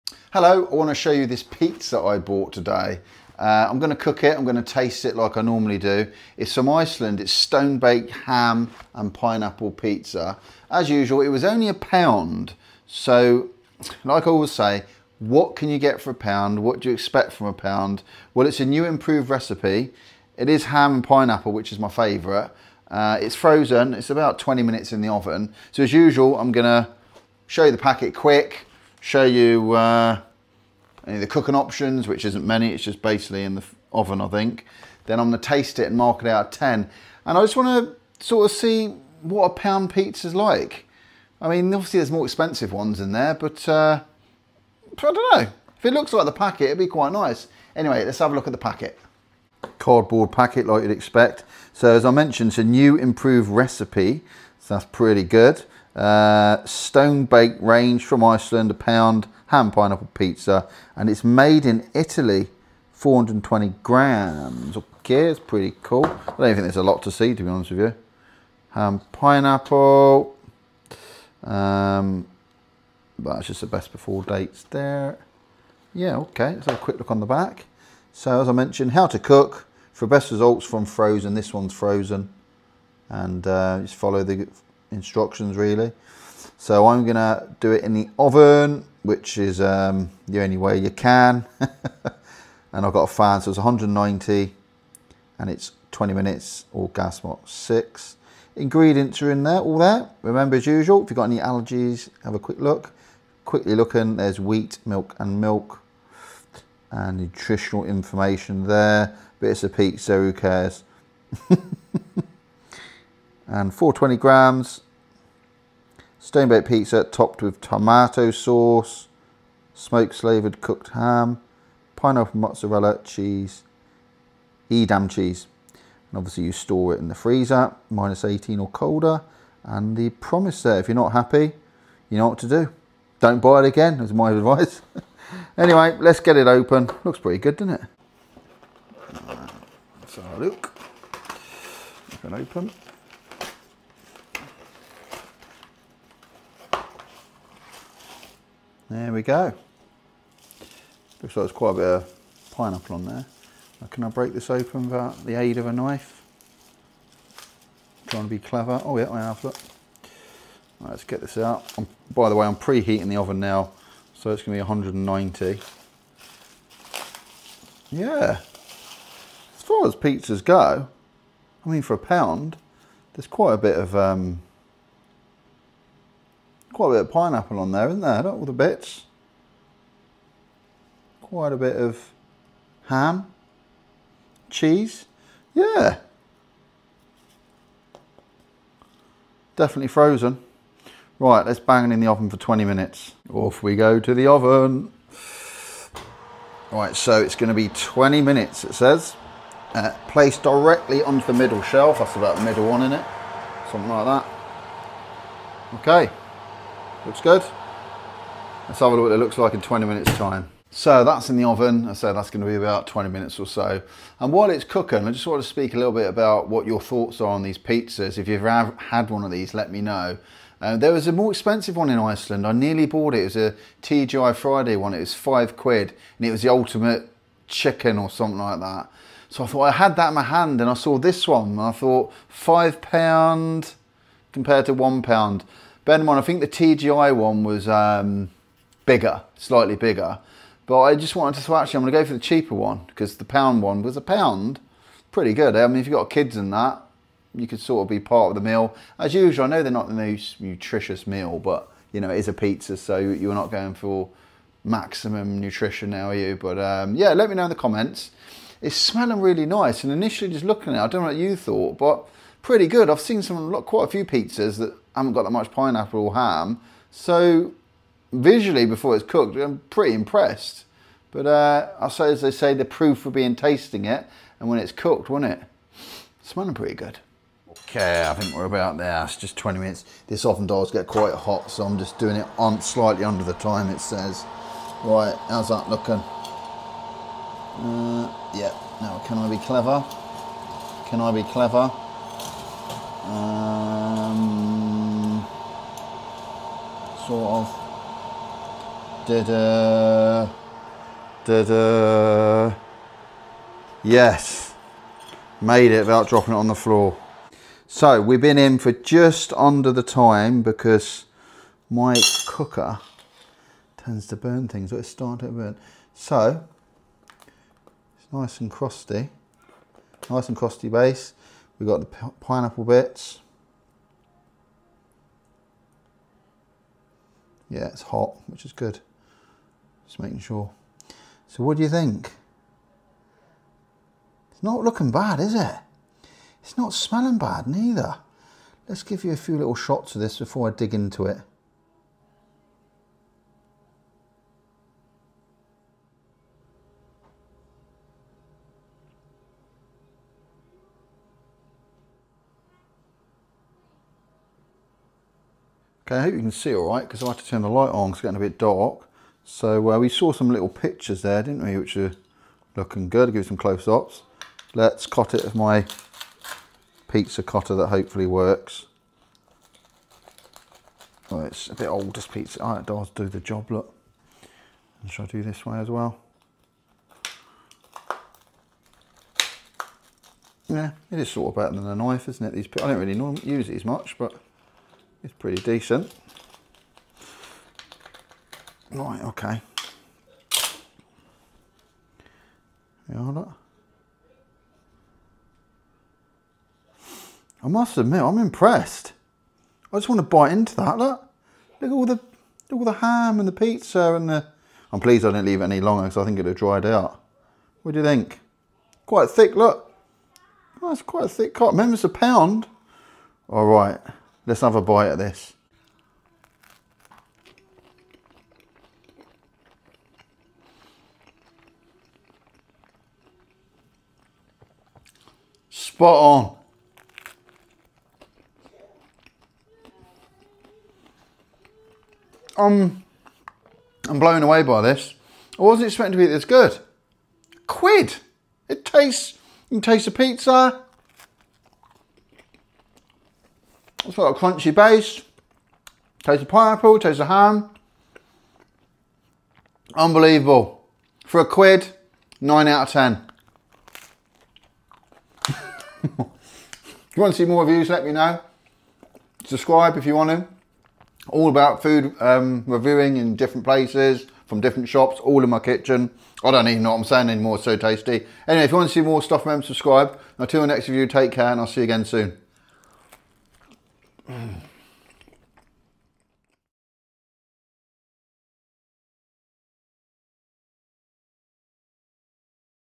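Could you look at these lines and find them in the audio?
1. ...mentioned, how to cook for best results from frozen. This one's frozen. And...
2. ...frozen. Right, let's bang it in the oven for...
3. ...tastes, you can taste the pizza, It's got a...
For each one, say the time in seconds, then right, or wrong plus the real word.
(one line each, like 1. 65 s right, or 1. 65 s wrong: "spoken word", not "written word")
1. 78 s right
2. 189 s right
3. 438 s right.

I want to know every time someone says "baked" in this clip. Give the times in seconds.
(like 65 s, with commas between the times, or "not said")
7 s, 57 s, 116 s.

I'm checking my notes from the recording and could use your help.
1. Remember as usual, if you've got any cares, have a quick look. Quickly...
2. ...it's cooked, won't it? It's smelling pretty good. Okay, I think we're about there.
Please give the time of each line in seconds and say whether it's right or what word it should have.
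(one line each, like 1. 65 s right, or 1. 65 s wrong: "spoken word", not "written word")
1. 100 s wrong: "allergies", not "cares"
2. 274 s right.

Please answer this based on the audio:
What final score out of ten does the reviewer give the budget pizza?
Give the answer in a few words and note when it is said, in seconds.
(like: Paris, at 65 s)
9, at 452 s.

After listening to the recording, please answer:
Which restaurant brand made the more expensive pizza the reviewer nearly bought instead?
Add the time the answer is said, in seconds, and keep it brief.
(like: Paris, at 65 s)
TGI Friday, at 223 s.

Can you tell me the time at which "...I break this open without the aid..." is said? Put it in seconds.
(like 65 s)
154 s.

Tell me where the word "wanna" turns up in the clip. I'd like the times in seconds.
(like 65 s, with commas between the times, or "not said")
0 s, 37 s.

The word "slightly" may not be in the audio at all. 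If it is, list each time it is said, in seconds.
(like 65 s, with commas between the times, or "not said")
239 s, 282 s.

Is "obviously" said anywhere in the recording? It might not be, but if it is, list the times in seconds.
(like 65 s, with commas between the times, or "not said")
41 s, 126 s.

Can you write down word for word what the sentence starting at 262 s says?
I've seen some, quite a few pizzas that haven't got that much pineapple or ham.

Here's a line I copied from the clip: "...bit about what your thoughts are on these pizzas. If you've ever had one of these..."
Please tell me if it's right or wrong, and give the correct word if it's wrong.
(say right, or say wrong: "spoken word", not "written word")
right.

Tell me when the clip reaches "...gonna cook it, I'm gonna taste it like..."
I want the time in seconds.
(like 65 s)
3 s.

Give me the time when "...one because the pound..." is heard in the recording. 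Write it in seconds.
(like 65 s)
242 s.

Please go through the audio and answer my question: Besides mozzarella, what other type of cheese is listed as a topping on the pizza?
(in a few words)
Edam.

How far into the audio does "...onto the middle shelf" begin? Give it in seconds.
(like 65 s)
201 s.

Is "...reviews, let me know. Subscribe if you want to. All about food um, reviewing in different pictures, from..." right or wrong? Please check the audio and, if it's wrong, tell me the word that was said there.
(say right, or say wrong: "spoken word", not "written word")
wrong: "places", not "pictures".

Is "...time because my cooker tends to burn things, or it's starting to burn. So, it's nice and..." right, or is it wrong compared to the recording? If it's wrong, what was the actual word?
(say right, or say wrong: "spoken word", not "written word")
right.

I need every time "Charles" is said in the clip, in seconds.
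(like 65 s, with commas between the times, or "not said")
not said.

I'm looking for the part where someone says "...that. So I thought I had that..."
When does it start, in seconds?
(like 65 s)
228 s.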